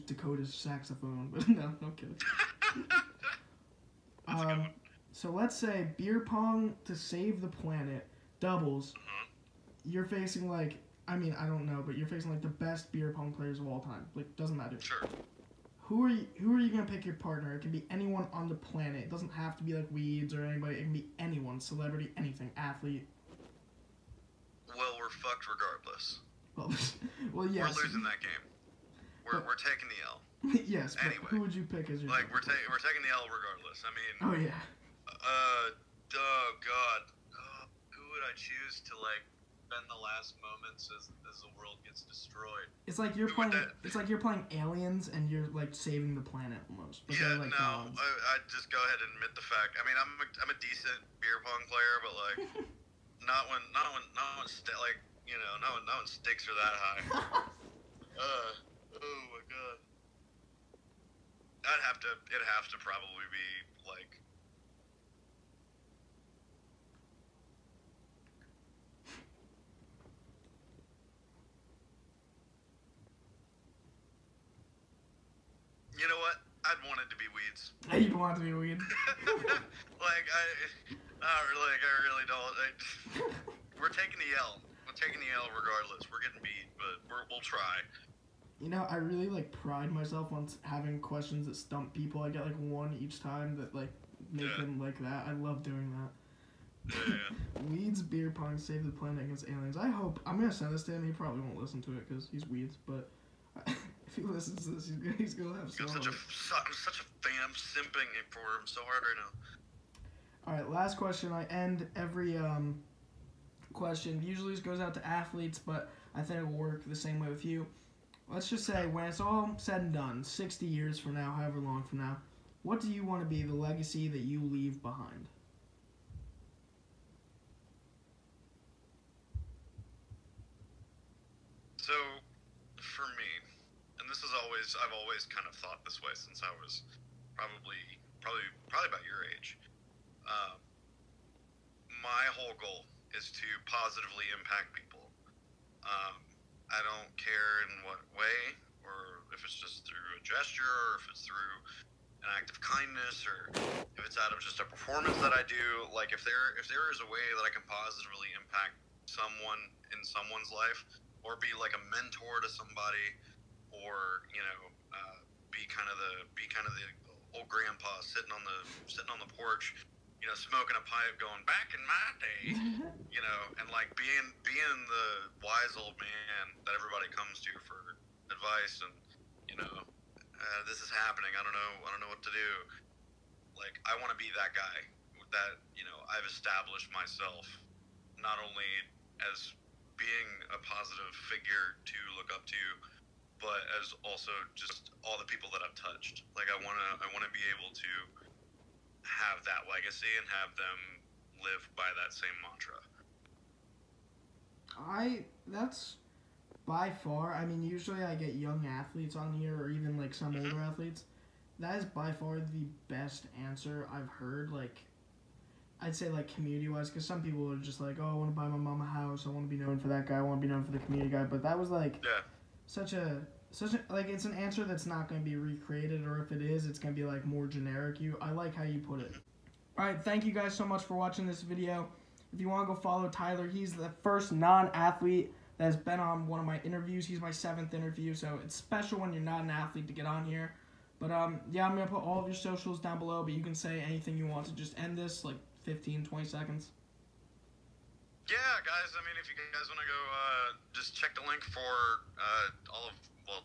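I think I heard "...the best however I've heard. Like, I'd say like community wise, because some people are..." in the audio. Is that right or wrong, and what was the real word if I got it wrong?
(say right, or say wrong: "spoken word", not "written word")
wrong: "answer", not "however".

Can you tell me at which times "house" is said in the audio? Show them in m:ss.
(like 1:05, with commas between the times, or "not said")
3:38.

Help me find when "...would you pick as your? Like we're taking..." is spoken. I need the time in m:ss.
0:31.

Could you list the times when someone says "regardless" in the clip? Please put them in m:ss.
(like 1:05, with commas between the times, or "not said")
0:25, 0:33, 1:25.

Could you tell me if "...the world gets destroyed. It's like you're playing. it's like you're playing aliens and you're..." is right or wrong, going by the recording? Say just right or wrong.
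right.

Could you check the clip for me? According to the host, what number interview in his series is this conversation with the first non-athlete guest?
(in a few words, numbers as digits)
7th.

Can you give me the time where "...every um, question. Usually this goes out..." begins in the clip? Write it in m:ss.
1:51.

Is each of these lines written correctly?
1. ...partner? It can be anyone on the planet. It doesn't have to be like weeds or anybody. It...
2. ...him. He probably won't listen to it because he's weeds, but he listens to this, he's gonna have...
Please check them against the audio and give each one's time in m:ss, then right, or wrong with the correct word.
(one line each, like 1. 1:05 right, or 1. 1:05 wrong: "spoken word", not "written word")
1. 0:17 right
2. 1:40 right.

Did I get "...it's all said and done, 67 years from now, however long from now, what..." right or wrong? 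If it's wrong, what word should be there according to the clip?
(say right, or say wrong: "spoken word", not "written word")
wrong: "60", not "67".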